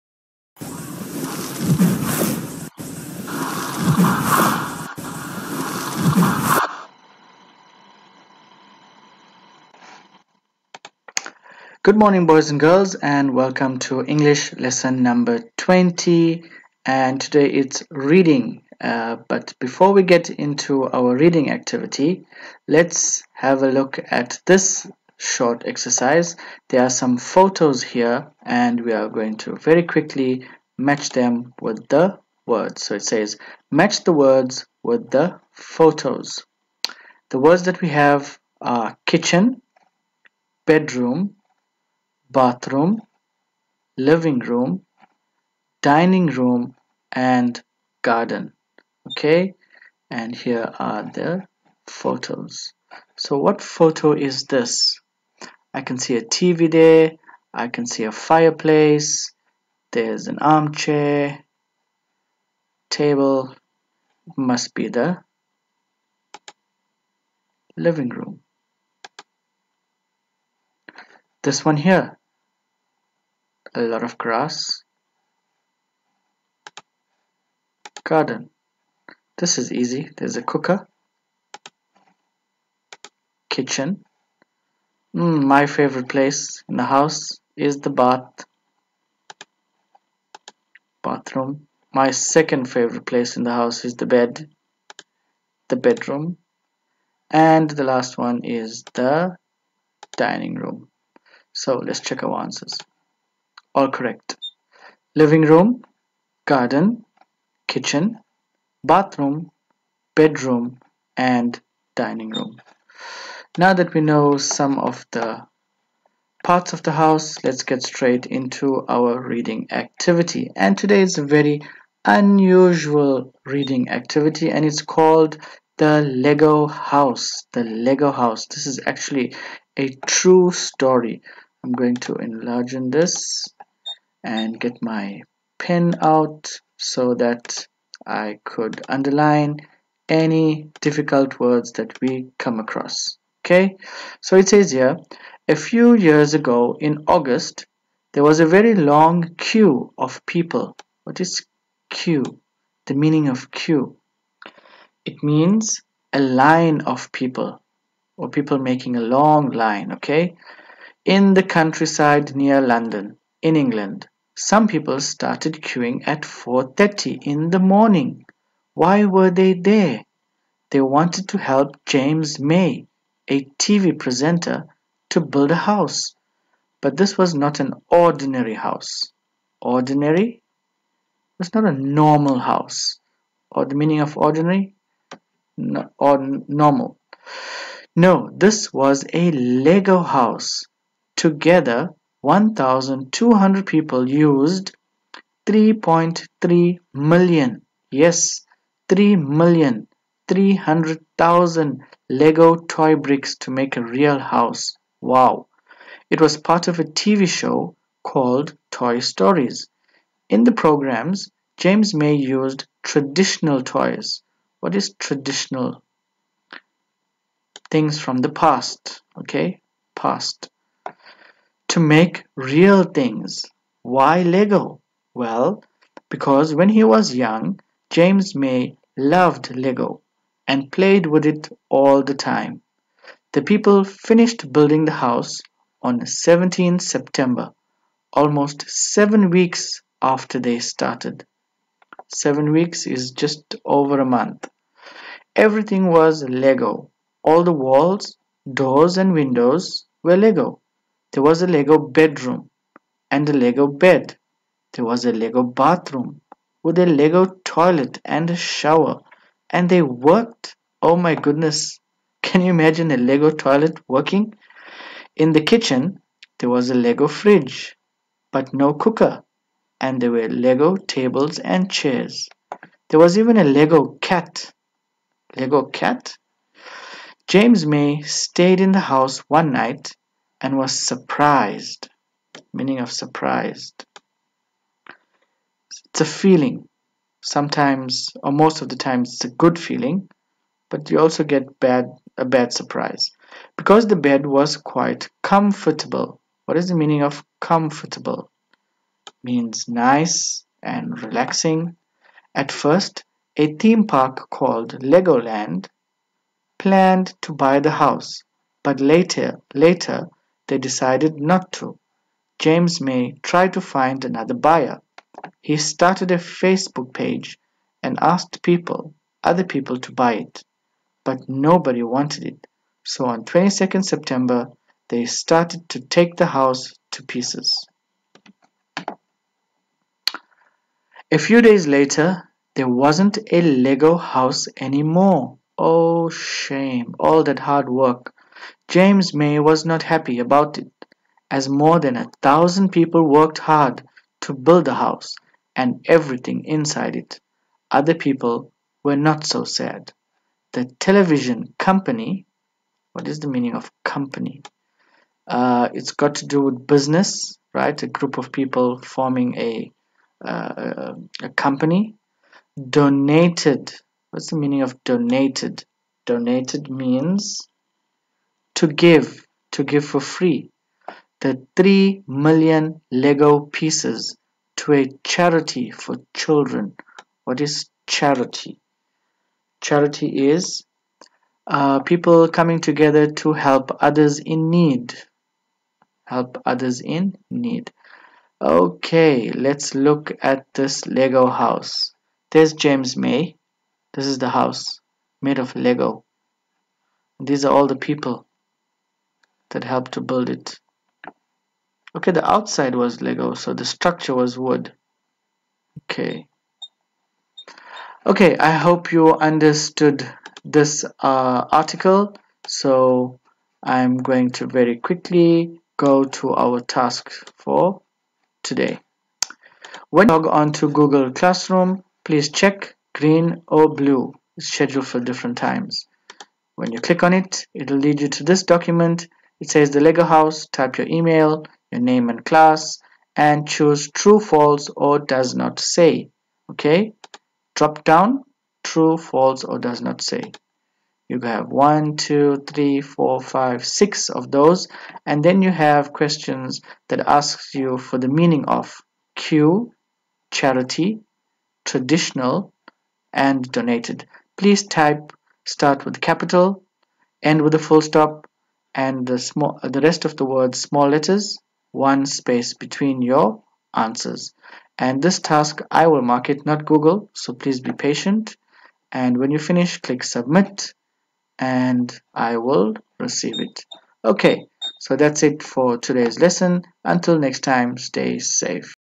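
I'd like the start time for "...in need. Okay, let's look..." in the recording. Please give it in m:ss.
6:26.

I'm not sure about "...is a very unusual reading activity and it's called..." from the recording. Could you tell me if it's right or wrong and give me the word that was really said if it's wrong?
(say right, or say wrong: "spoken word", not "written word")
right.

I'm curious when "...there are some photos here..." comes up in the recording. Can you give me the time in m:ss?
0:26.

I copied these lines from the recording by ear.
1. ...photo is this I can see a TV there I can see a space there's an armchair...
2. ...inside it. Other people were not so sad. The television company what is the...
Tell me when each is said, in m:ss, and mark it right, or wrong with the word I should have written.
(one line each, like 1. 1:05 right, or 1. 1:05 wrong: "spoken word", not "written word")
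1. 0:53 wrong: "fireplace", not "space"
2. 5:46 right.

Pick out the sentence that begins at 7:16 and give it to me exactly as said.
Okay, drop down true, false, or does not say.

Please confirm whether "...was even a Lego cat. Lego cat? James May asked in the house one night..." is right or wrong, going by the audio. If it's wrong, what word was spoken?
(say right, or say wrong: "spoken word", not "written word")
wrong: "stayed", not "asked".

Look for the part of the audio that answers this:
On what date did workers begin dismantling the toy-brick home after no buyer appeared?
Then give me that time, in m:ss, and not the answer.
5:23.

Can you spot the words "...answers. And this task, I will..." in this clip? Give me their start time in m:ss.
7:43.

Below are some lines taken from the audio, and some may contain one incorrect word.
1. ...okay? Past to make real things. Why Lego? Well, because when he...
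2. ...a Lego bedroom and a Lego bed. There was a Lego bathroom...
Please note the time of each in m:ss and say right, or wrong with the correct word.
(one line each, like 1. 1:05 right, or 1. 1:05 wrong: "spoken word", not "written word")
1. 3:39 right
2. 4:11 right.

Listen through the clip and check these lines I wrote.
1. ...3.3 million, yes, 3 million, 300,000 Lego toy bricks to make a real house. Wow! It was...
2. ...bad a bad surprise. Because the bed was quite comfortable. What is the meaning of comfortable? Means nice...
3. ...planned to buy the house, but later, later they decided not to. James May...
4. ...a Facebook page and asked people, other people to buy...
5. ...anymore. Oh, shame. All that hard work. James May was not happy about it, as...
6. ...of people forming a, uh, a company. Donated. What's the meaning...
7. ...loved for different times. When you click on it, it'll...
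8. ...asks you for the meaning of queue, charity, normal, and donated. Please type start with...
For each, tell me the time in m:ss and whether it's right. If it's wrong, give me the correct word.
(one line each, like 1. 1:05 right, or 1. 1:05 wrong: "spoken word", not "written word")
1. 3:15 right
2. 4:51 right
3. 5:06 right
4. 5:16 right
5. 5:34 right
6. 5:58 right
7. 7:04 wrong: "scheduled", not "loved"
8. 7:27 wrong: "traditional", not "normal".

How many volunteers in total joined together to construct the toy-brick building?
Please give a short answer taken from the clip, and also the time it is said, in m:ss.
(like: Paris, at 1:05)
1,200, at 3:12.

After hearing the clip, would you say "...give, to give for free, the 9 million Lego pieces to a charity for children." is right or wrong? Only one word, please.
wrong.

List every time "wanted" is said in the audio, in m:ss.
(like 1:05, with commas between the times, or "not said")
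2:50, 5:21.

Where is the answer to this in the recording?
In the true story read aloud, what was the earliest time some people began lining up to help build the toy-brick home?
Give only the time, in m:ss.
2:46.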